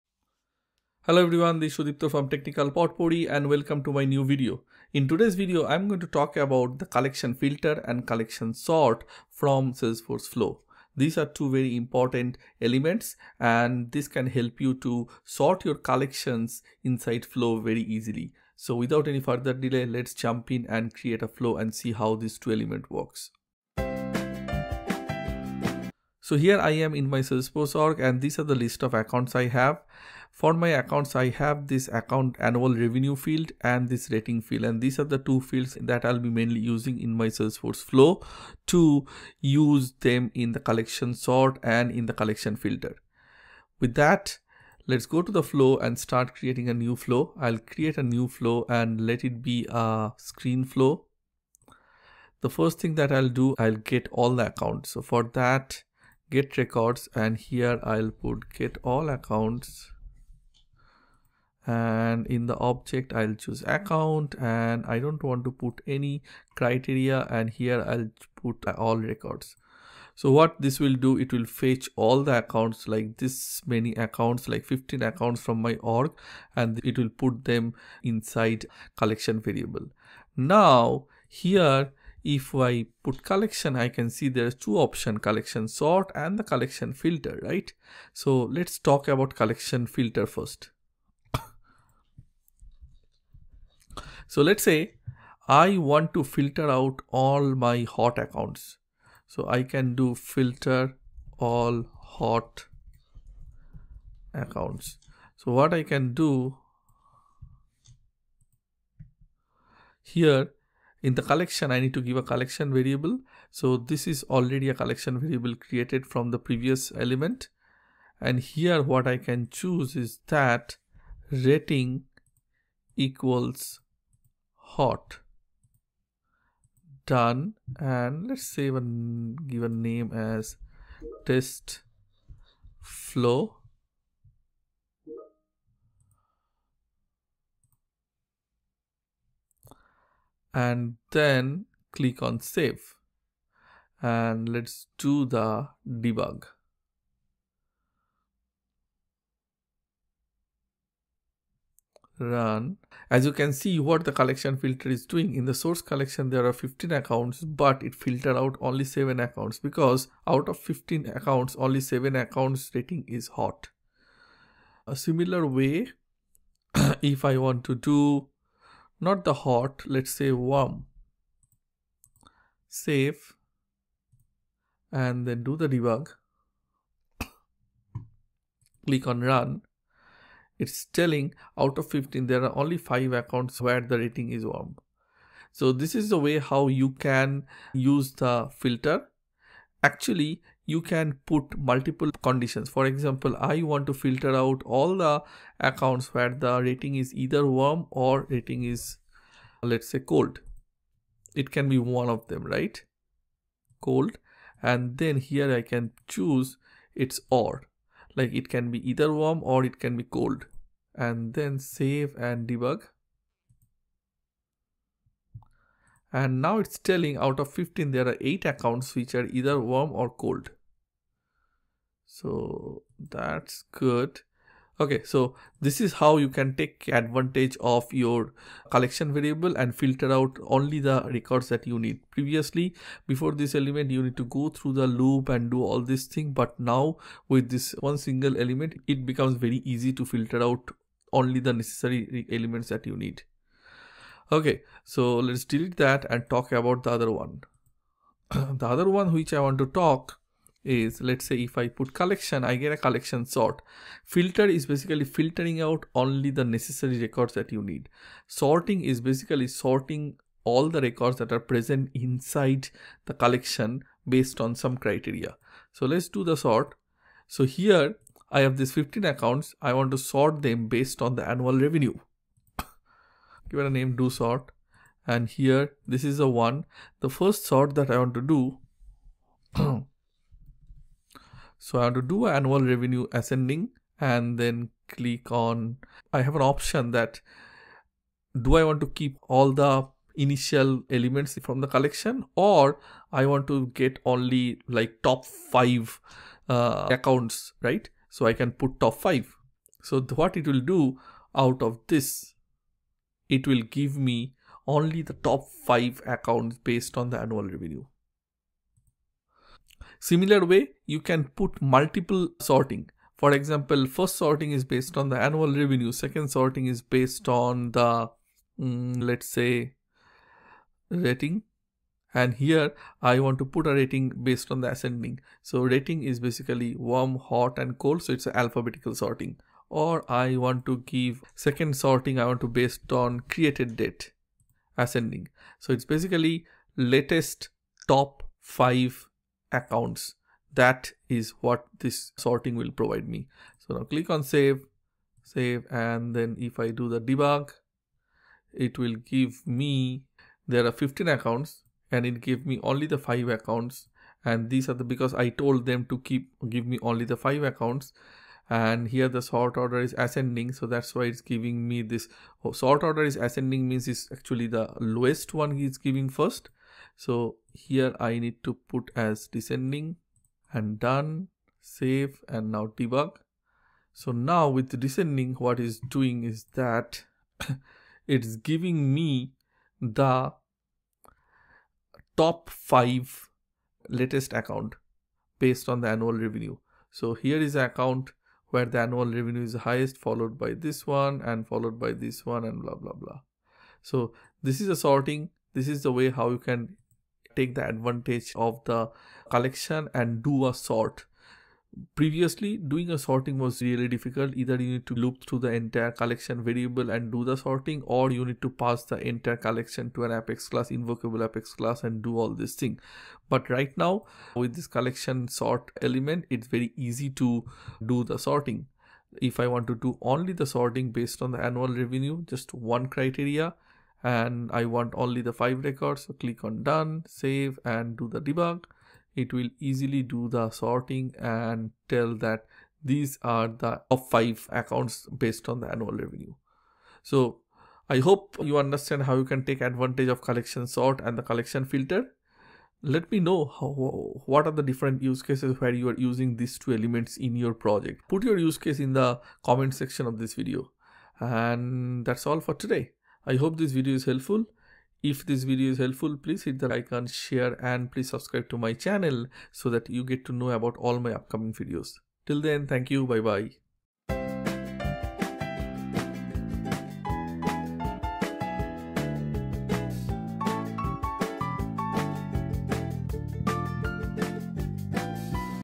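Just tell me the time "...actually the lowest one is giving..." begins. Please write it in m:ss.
6:04.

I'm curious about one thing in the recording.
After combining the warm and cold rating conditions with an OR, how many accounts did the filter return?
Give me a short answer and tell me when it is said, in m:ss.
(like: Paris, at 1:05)
8, at 3:38.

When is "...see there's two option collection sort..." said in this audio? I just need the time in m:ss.
1:24.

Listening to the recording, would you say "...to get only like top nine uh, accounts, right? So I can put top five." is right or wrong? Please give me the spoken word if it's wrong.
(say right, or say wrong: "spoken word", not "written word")
wrong: "five", not "nine".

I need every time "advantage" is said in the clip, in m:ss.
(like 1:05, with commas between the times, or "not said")
3:46, 6:37, 7:19.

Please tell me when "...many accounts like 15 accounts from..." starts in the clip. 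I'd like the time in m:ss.
1:13.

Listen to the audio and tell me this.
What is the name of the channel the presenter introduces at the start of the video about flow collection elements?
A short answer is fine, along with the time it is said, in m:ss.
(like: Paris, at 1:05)
Technical Potpourri, at 0:02.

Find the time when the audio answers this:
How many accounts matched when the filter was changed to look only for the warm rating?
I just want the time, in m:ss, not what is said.
3:02.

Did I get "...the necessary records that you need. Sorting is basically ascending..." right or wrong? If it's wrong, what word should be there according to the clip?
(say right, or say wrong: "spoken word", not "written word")
wrong: "sorting", not "ascending".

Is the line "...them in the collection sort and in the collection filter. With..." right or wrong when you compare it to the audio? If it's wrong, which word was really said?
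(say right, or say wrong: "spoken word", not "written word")
right.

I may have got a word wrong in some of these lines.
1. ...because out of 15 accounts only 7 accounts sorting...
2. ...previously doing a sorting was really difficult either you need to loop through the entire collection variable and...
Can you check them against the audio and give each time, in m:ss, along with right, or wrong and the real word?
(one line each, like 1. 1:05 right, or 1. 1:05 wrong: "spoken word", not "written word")
1. 2:39 wrong: "rating", not "sorting"
2. 6:41 right.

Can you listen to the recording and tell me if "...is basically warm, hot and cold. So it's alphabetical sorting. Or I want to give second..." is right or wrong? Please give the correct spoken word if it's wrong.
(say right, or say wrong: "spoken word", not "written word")
right.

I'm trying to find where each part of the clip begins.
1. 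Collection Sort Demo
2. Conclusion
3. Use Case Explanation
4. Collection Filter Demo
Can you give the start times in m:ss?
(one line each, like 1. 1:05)
1. 4:07
2. 7:17
3. 0:26
4. 0:46.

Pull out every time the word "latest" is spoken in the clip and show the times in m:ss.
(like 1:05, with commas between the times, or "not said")
5:36, 6:23.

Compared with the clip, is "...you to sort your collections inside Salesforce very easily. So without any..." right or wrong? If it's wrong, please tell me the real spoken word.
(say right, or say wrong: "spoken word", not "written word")
wrong: "Flow", not "Salesforce".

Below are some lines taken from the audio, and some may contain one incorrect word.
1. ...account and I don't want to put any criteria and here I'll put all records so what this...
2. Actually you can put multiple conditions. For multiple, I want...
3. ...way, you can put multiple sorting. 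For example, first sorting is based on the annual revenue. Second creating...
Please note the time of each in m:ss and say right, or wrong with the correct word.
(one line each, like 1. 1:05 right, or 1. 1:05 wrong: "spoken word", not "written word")
1. 1:03 right
2. 3:09 wrong: "example", not "multiple"
3. 5:10 wrong: "sorting", not "creating".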